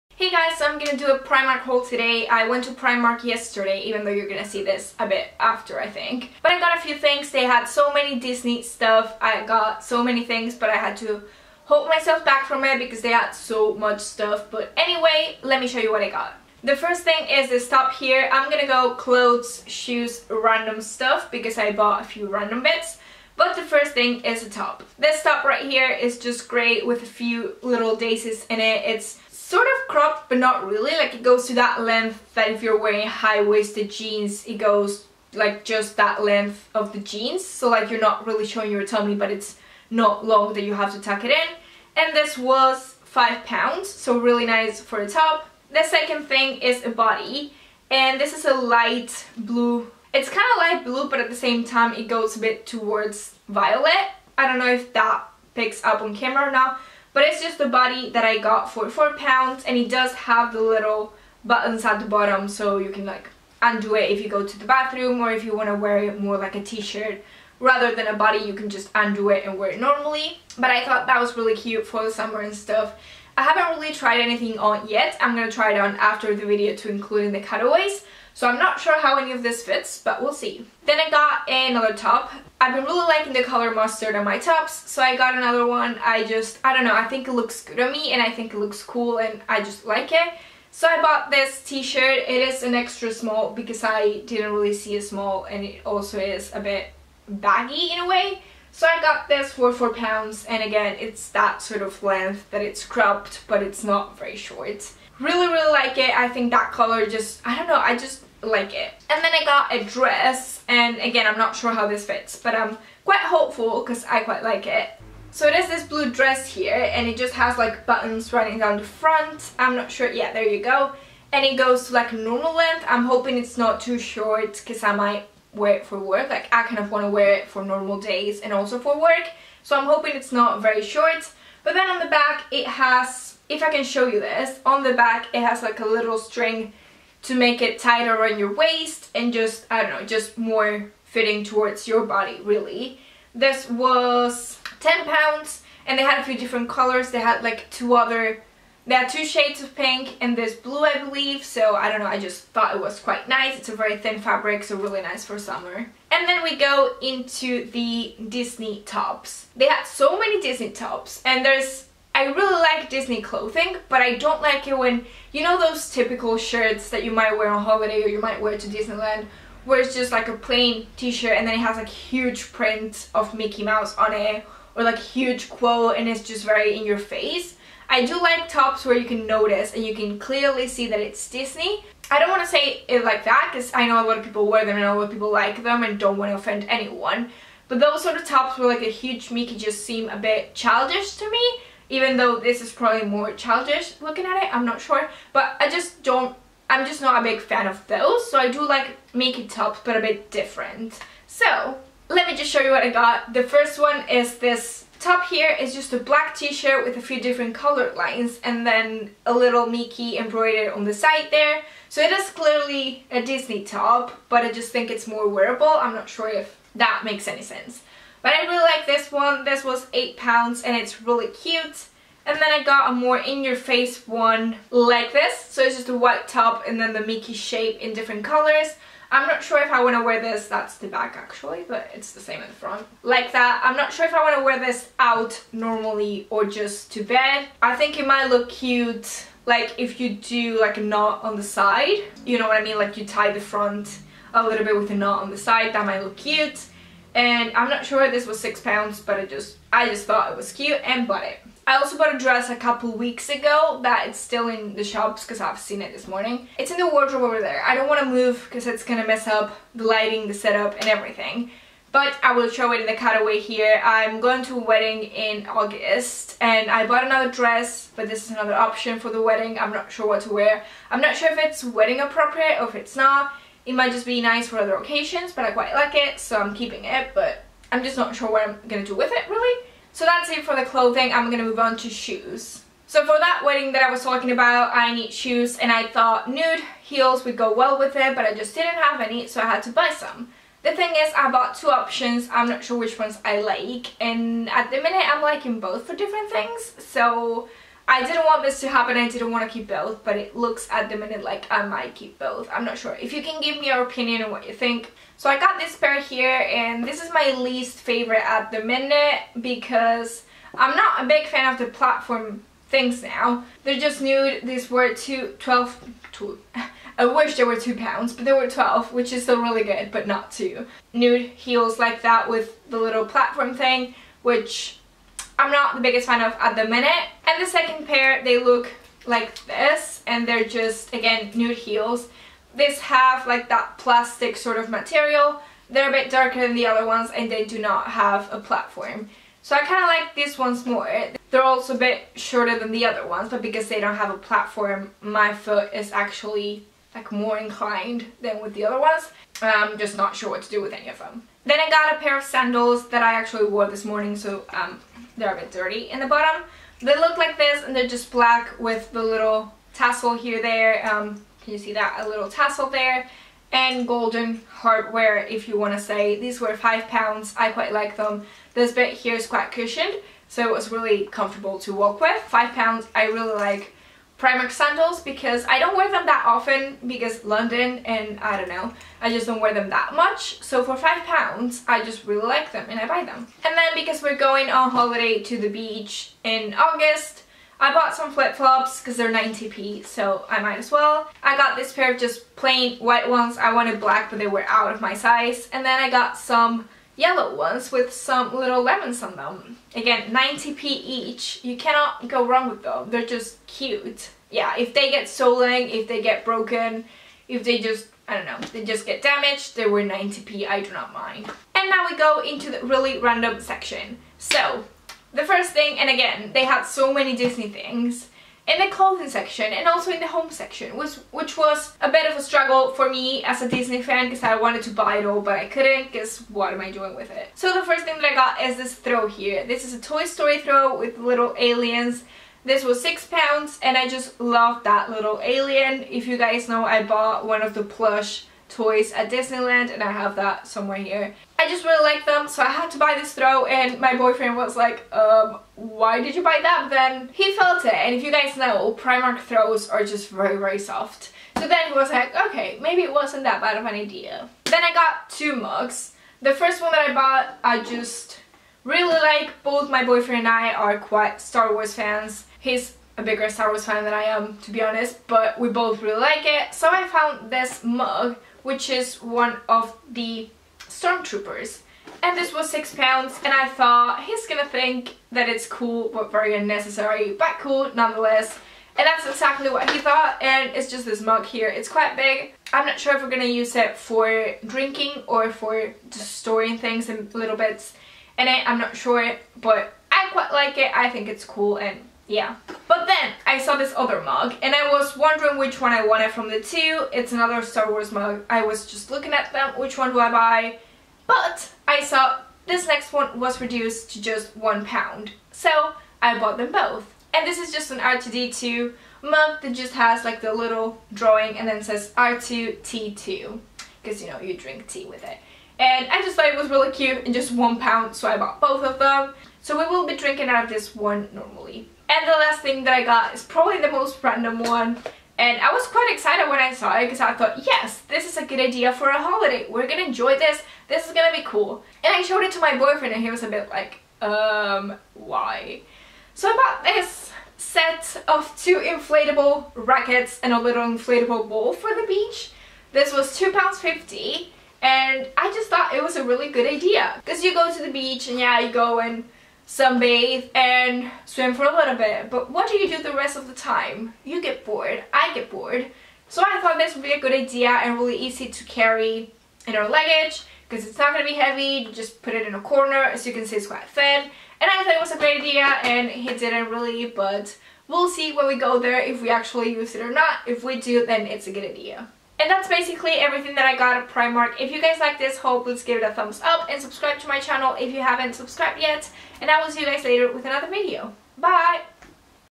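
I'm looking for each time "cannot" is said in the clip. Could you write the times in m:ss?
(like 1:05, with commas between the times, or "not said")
6:41.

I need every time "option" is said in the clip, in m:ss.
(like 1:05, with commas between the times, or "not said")
4:28, 4:51.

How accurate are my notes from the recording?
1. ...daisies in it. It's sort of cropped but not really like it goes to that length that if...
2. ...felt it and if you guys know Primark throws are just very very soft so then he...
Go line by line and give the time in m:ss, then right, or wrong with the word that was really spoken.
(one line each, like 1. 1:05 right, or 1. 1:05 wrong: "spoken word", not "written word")
1. 0:27 right
2. 7:27 right.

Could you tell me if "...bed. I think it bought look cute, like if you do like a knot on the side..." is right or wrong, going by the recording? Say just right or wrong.
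wrong.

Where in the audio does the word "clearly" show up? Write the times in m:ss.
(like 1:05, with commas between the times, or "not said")
3:00, 3:32.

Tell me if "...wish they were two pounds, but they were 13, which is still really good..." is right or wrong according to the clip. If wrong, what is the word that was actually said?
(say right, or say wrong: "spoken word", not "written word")
wrong: "12", not "13".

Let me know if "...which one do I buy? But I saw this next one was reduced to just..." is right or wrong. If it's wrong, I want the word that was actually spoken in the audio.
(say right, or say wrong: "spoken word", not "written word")
right.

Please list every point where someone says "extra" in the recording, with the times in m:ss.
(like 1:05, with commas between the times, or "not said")
1:32.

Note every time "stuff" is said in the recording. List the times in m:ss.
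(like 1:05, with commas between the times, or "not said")
0:08, 0:13, 0:20, 1:12.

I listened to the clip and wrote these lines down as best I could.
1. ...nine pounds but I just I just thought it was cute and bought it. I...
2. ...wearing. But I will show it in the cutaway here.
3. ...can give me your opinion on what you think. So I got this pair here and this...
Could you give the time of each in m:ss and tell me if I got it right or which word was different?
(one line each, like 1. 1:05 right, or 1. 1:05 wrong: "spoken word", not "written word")
1. 4:08 wrong: "six", not "nine"
2. 4:20 wrong: "everything", not "wearing"
3. 5:03 right.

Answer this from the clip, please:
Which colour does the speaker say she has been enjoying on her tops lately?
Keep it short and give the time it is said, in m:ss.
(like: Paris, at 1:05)
Mustard, at 1:23.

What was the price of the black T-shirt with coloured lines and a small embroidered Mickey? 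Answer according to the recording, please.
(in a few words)
£8.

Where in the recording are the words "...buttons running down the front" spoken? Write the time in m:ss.
1:57.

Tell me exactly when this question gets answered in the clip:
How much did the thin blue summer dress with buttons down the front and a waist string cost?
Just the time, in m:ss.
2:24.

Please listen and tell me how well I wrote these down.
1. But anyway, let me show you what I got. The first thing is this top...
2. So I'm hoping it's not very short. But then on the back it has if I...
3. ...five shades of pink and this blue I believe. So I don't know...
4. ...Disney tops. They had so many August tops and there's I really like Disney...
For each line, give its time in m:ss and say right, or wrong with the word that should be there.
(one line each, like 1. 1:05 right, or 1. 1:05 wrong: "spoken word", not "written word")
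1. 0:14 right
2. 2:09 right
3. 2:29 wrong: "two", not "five"
4. 2:38 wrong: "Disney", not "August".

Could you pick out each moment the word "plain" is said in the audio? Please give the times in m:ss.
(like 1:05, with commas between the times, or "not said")
2:50, 6:32.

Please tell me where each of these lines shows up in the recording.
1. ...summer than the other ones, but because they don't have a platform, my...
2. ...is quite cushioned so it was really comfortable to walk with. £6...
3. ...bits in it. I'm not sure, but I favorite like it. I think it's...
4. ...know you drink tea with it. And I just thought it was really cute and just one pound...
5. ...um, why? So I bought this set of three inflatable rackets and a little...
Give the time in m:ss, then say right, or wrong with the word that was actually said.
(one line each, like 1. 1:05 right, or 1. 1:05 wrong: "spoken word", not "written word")
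1. 5:42 wrong: "shorter", not "summer"
2. 6:09 wrong: "5", not "6"
3. 8:07 wrong: "quite", not "favorite"
4. 8:34 right
5. 8:54 wrong: "two", not "three".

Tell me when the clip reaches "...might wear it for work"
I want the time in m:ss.
2:04.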